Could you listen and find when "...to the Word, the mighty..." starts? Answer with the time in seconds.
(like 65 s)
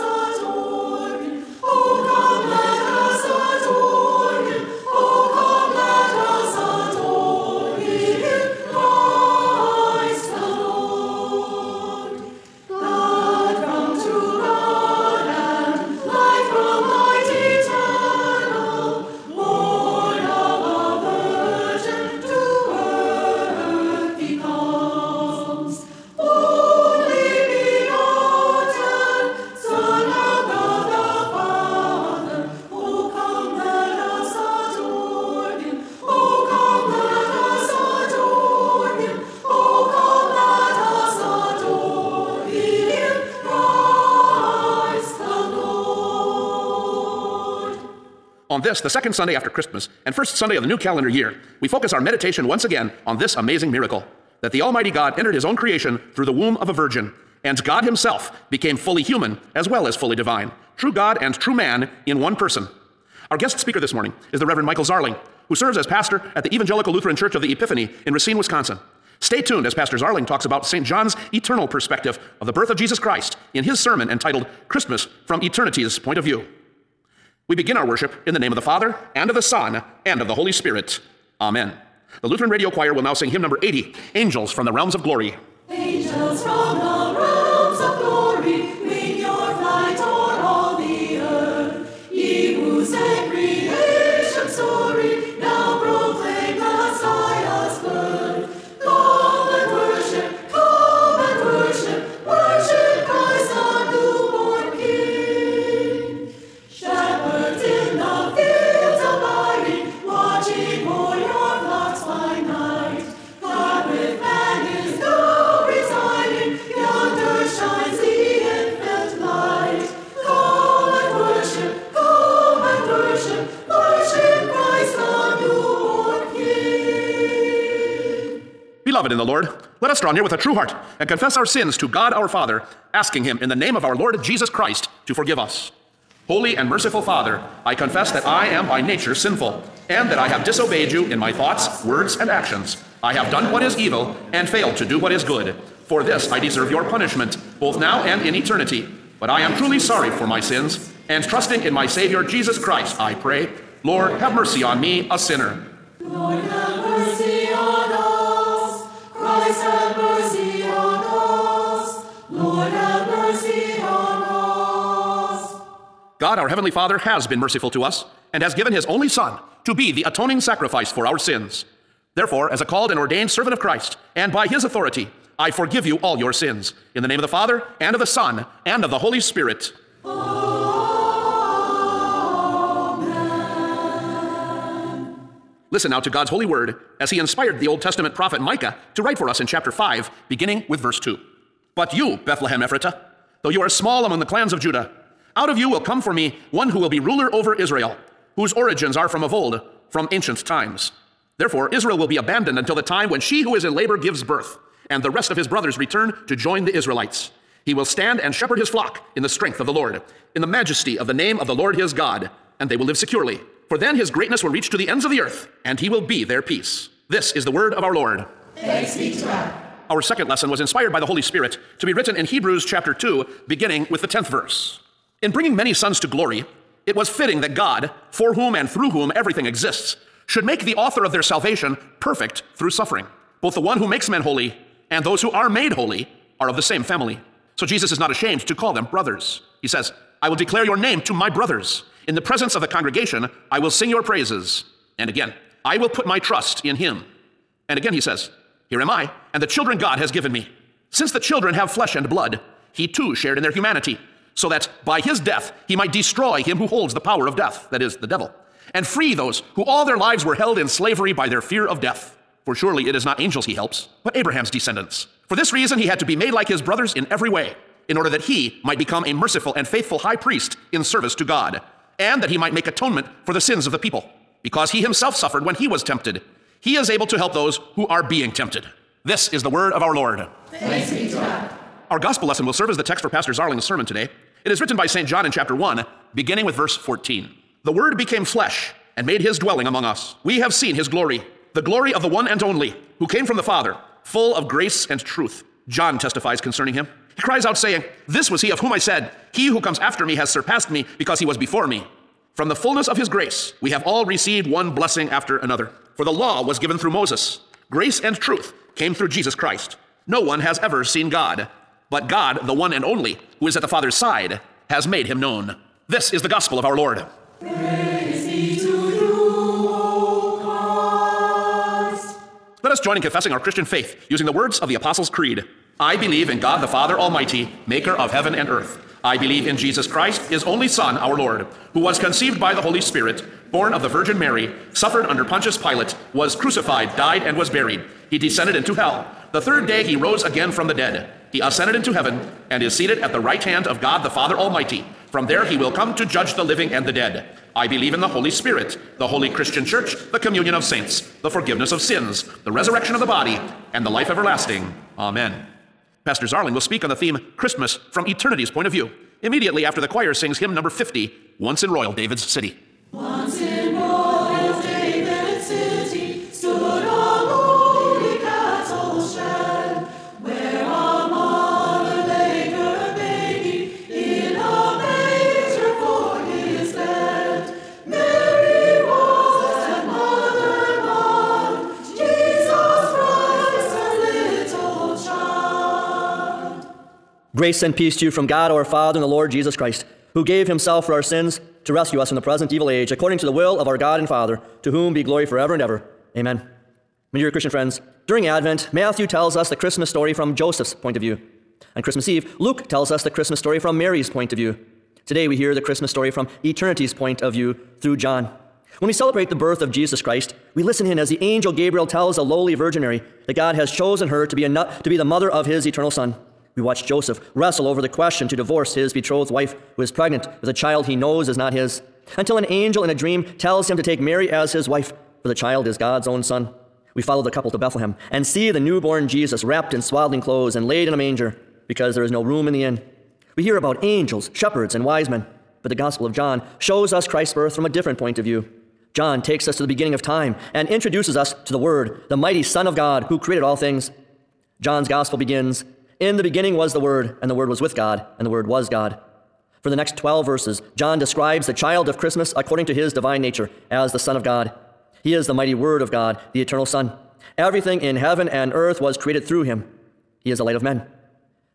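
441 s.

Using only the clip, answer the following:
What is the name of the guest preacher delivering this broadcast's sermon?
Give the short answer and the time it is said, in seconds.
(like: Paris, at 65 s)
Michael Zarling, at 64 s.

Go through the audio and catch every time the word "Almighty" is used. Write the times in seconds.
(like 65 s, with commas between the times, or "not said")
54 s, 326 s, 344 s.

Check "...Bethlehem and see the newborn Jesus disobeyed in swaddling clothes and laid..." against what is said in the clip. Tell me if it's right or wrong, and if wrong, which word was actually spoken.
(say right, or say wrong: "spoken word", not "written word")
wrong: "wrapped", not "disobeyed".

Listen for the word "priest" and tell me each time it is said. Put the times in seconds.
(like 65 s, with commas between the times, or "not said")
270 s.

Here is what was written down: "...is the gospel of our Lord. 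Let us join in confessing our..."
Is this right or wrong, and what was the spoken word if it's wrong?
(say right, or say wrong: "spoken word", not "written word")
right.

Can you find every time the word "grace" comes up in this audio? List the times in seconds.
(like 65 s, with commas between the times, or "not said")
294 s, 303 s, 307 s, 387 s.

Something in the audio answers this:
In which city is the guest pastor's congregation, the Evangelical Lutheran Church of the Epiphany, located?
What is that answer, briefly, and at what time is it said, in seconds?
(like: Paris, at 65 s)
Racine, Wisconsin, at 68 s.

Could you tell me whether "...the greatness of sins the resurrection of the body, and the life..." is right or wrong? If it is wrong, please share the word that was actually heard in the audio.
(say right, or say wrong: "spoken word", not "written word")
wrong: "forgiveness", not "greatness".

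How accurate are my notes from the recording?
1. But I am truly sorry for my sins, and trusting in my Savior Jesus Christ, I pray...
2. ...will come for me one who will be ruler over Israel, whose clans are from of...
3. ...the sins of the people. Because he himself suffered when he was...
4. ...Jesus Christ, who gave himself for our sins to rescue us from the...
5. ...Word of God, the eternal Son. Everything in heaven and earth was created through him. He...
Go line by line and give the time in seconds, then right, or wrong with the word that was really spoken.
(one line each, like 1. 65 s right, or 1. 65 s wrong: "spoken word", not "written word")
1. 149 s right
2. 195 s wrong: "origins", not "clans"
3. 273 s right
4. 389 s right
5. 455 s right.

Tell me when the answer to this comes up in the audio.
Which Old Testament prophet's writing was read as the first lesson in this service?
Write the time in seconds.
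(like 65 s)
188 s.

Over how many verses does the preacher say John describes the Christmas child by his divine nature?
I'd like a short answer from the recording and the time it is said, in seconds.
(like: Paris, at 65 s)
12, at 449 s.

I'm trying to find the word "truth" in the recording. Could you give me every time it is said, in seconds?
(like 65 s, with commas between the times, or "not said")
294 s, 308 s.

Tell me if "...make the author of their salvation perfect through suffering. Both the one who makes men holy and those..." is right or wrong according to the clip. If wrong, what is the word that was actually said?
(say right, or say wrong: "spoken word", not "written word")
right.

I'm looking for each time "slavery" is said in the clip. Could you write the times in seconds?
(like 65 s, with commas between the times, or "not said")
260 s.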